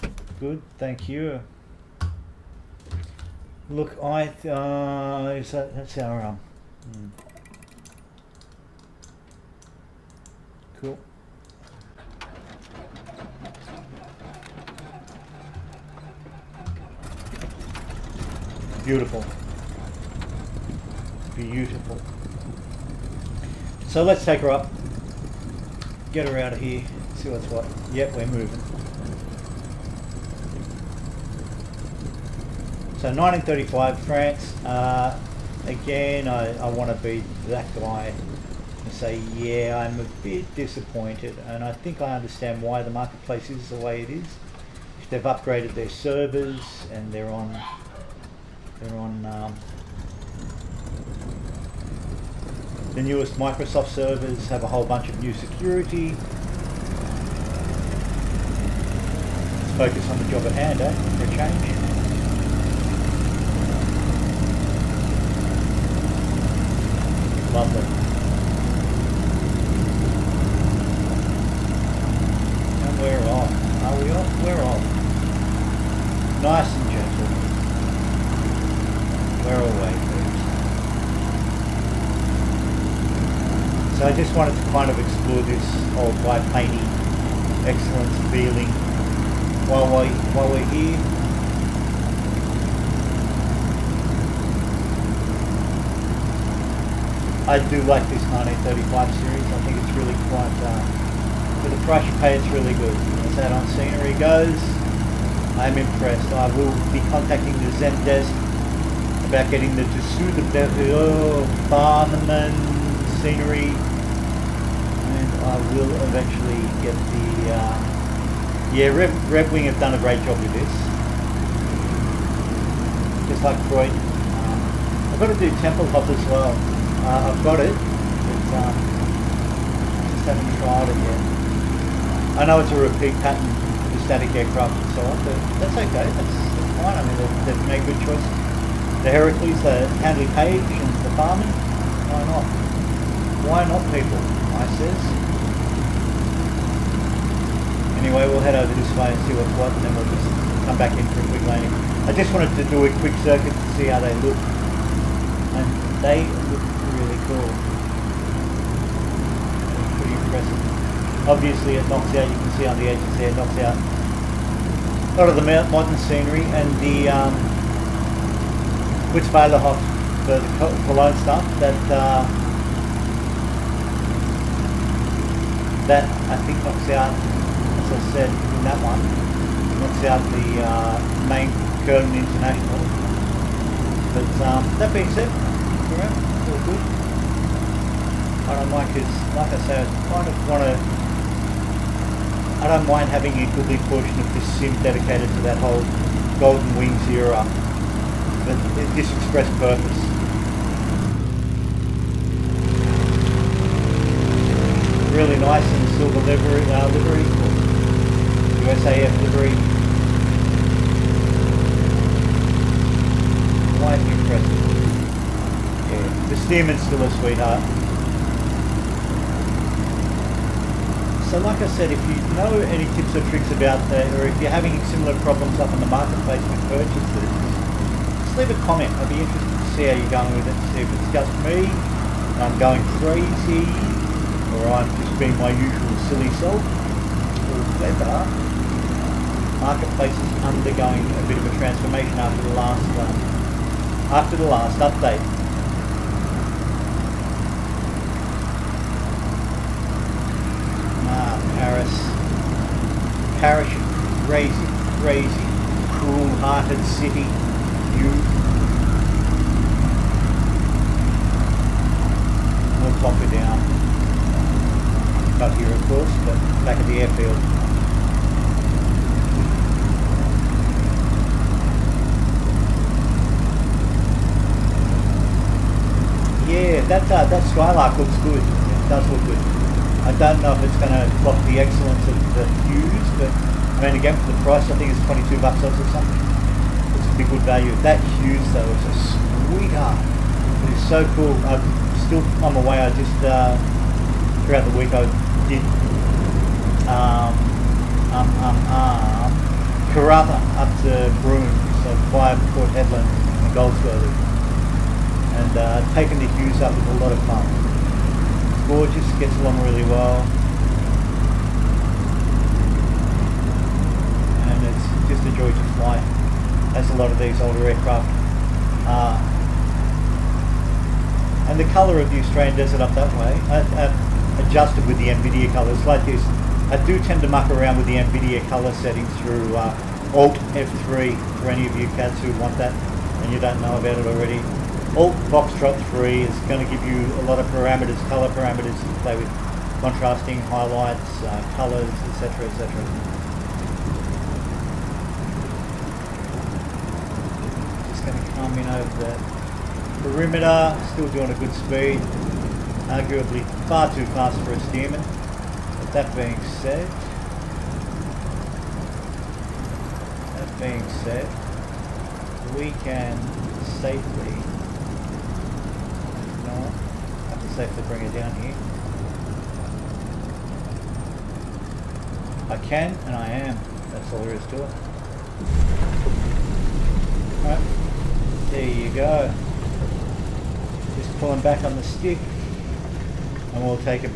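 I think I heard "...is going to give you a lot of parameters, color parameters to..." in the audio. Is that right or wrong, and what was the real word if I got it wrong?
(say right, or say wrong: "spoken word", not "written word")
right.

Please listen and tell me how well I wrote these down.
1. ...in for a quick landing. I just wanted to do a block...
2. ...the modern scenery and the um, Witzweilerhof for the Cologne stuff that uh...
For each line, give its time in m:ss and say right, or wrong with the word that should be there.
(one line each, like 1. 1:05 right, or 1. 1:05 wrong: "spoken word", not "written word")
1. 2:30 wrong: "quick", not "block"
2. 2:45 right.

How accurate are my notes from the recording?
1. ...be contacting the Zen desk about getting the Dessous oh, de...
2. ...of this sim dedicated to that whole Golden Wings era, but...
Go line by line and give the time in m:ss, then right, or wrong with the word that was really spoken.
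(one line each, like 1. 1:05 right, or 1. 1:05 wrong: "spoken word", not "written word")
1. 1:46 right
2. 3:14 right.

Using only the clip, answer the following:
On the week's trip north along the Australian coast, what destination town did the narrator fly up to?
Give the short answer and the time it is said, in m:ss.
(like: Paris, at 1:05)
Broome, at 5:01.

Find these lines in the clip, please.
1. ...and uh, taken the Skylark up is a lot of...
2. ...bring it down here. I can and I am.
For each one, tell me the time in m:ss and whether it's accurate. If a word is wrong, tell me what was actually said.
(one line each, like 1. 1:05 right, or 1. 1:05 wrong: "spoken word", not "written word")
1. 5:05 wrong: "Hughes", not "Skylark"
2. 6:07 right.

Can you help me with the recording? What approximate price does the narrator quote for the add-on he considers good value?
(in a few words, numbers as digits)
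22 bucks.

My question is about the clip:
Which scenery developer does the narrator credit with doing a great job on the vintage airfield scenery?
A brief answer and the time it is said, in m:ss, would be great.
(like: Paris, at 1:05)
Red Wing, at 1:59.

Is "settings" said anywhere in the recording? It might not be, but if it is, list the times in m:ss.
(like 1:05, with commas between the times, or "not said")
5:28.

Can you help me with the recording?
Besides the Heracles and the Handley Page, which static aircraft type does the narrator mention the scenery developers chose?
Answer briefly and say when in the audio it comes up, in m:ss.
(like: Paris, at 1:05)
Farman, at 2:21.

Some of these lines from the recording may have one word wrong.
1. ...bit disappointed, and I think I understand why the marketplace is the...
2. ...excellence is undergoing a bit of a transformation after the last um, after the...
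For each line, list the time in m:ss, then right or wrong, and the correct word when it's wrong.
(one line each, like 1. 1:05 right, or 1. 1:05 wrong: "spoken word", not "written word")
1. 0:40 right
2. 3:59 wrong: "marketplace", not "excellence".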